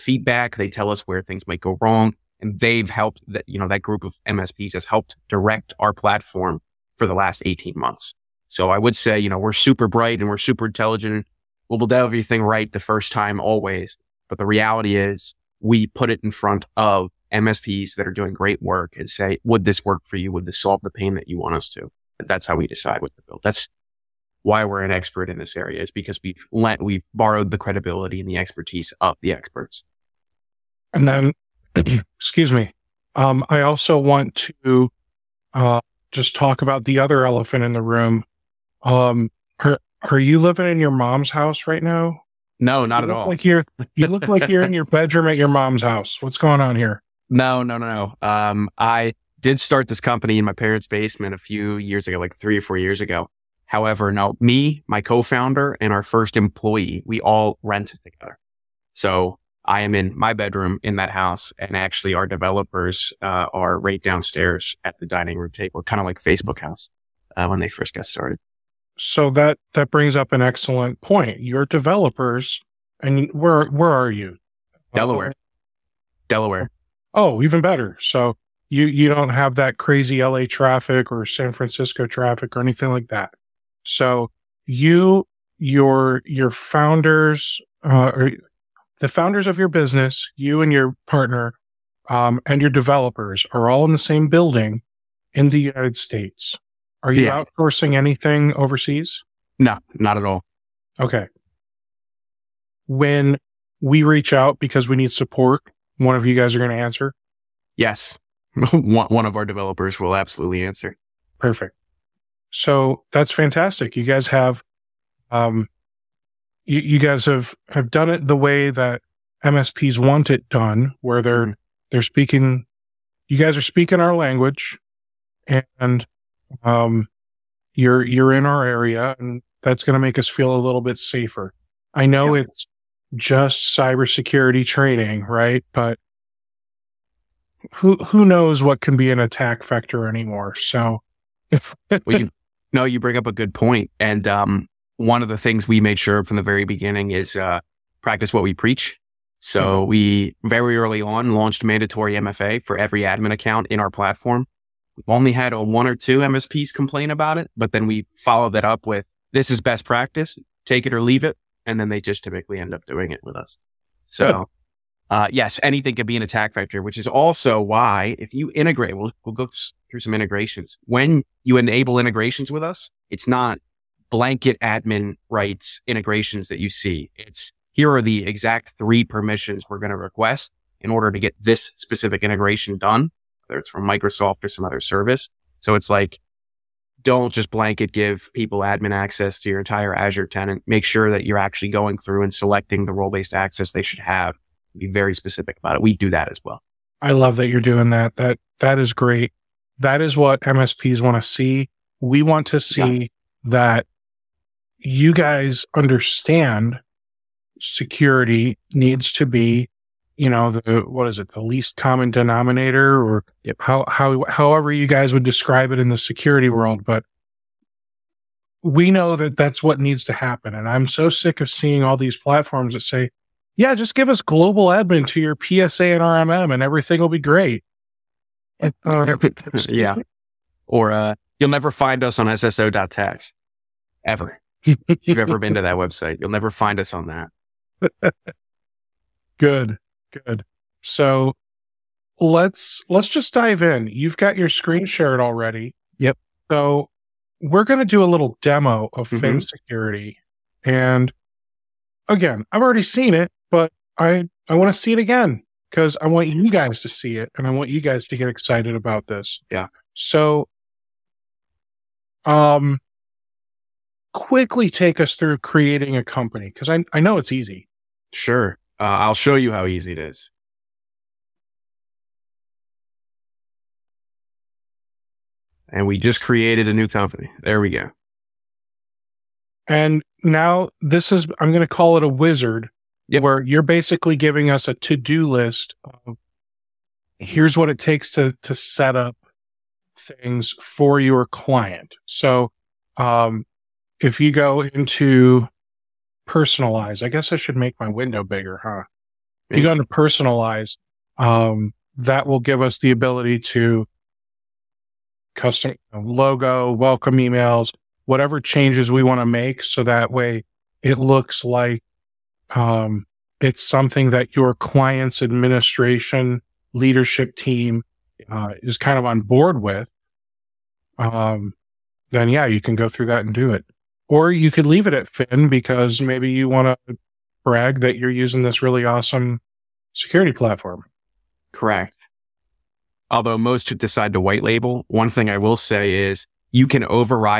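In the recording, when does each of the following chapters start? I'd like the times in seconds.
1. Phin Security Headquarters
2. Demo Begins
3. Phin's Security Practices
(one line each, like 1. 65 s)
1. 32 s
2. 242 s
3. 142 s.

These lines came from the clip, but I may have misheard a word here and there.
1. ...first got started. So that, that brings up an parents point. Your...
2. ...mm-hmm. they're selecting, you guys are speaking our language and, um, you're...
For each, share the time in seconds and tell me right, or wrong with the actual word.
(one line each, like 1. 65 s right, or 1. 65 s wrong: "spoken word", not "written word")
1. 67 s wrong: "excellent", not "parents"
2. 121 s wrong: "speaking", not "selecting".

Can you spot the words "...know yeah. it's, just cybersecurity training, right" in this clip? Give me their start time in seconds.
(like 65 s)
132 s.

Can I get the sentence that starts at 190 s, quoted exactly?
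Make sure that you're actually going through and selecting the role based access they should have.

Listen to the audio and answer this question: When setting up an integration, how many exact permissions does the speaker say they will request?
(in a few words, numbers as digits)
3.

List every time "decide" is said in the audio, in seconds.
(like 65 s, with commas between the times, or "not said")
22 s, 333 s.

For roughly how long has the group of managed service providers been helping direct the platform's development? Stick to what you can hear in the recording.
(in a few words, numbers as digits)
18 months.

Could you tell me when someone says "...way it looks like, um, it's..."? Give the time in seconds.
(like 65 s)
310 s.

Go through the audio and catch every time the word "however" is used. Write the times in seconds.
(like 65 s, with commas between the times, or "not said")
53 s, 214 s.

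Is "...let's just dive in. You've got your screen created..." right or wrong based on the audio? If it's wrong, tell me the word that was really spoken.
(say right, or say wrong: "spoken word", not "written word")
wrong: "shared", not "created".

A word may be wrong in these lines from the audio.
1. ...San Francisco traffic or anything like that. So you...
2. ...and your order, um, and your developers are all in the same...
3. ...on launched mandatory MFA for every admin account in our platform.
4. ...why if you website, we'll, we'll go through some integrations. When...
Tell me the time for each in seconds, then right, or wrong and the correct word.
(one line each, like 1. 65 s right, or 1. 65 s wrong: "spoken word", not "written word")
1. 81 s right
2. 90 s wrong: "partner", not "order"
3. 151 s right
4. 167 s wrong: "integrate", not "website".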